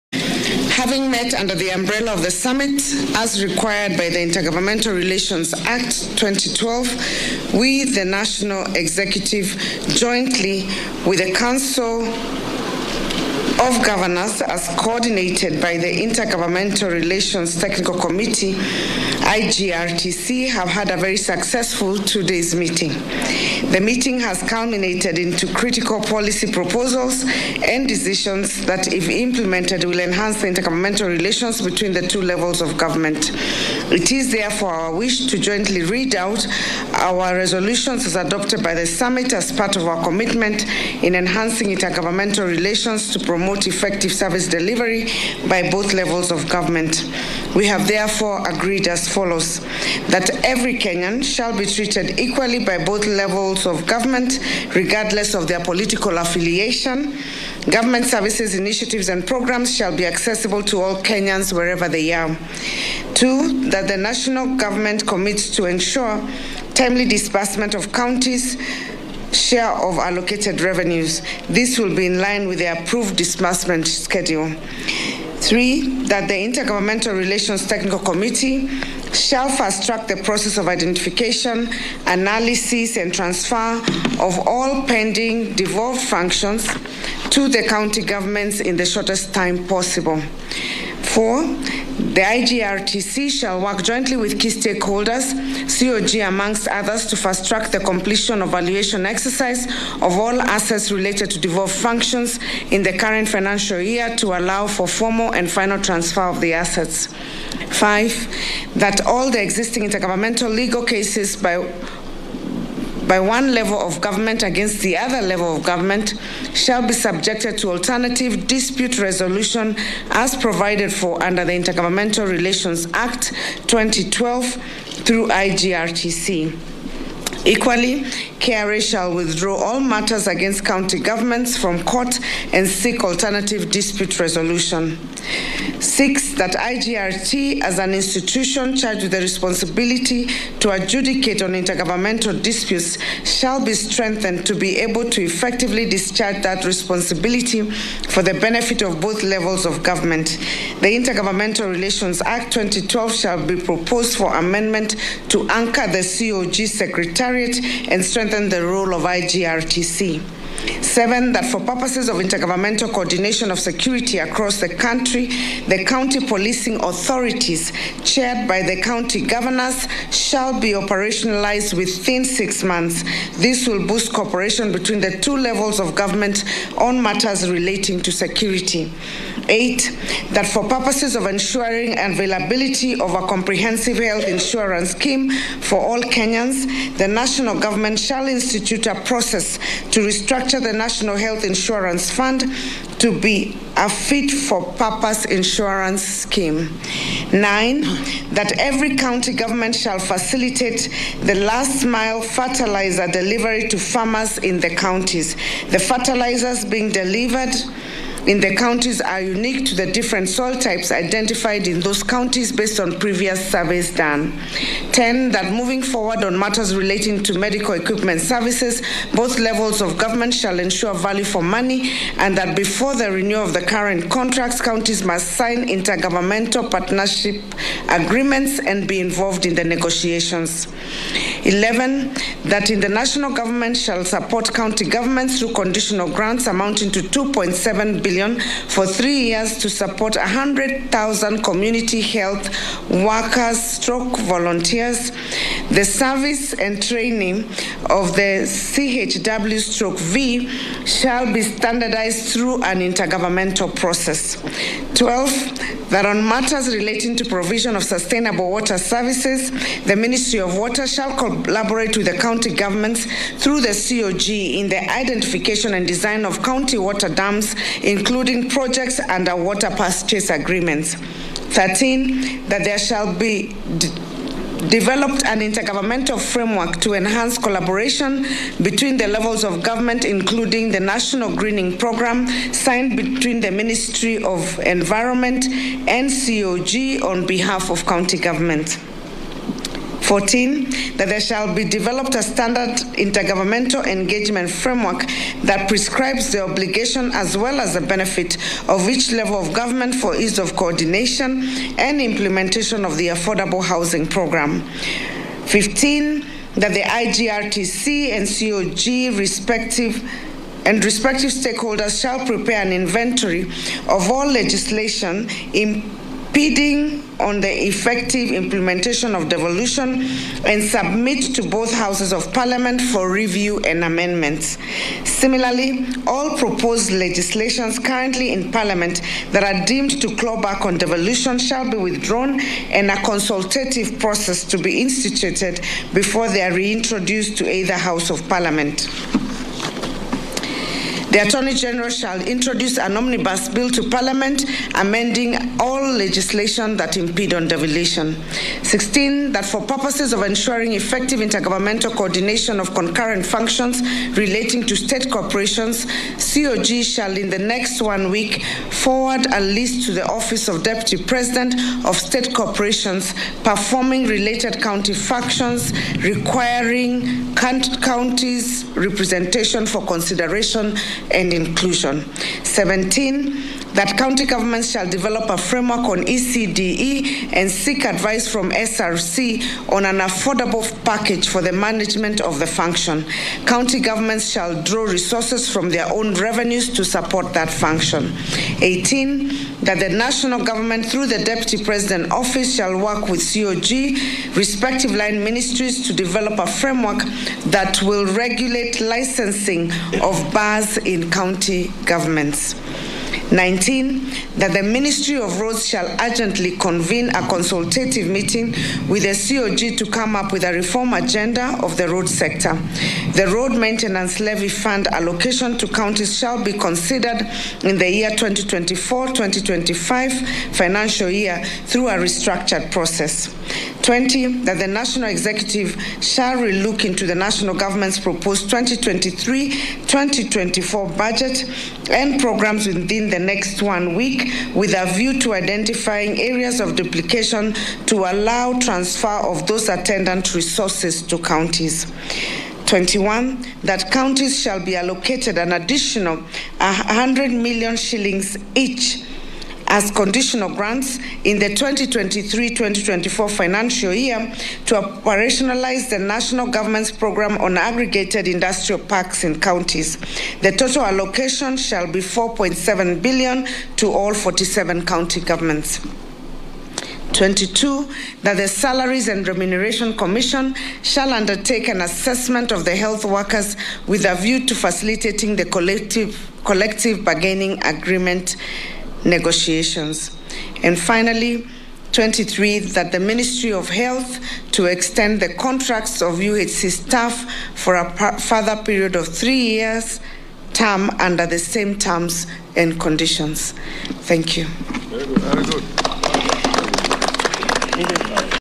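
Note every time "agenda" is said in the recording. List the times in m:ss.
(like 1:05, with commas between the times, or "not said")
6:50.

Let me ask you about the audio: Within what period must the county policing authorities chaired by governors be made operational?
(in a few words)
six months.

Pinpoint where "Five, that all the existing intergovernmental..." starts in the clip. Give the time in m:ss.
1:47.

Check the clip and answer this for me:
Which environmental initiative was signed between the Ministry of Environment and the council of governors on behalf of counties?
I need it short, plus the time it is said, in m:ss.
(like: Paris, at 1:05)
National Greening Program, at 4:40.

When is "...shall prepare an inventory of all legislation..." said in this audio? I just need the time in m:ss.
5:12.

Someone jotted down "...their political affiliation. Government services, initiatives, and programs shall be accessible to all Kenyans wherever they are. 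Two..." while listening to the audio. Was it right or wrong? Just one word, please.
right.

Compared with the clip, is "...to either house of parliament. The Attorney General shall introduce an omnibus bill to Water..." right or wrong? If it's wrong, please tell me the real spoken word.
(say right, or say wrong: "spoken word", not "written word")
wrong: "Parliament", not "Water".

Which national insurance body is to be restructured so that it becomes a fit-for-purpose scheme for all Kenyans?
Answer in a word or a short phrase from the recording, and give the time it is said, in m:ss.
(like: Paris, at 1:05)
National Health Insurance Fund, at 3:10.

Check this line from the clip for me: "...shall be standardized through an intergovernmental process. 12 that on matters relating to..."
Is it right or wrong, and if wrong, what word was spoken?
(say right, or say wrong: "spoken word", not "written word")
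right.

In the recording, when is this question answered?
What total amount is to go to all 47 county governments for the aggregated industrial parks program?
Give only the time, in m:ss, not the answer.
7:41.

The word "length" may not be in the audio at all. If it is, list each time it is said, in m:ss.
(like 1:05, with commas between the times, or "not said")
not said.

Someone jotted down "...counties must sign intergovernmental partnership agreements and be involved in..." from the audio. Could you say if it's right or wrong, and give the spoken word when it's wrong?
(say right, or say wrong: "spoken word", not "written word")
right.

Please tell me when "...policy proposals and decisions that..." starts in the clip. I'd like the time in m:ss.
0:26.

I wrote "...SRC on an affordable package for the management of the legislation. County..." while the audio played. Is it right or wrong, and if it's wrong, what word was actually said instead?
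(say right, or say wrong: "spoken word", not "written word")
wrong: "function", not "legislation".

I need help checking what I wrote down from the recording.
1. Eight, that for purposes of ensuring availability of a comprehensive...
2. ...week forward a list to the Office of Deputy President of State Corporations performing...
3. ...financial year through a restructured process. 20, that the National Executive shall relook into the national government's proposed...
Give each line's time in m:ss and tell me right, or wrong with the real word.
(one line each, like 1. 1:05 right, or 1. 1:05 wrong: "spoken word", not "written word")
1. 2:59 right
2. 5:58 right
3. 7:00 right.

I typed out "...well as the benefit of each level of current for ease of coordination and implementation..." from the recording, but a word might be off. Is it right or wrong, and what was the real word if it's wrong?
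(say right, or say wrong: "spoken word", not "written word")
wrong: "government", not "current".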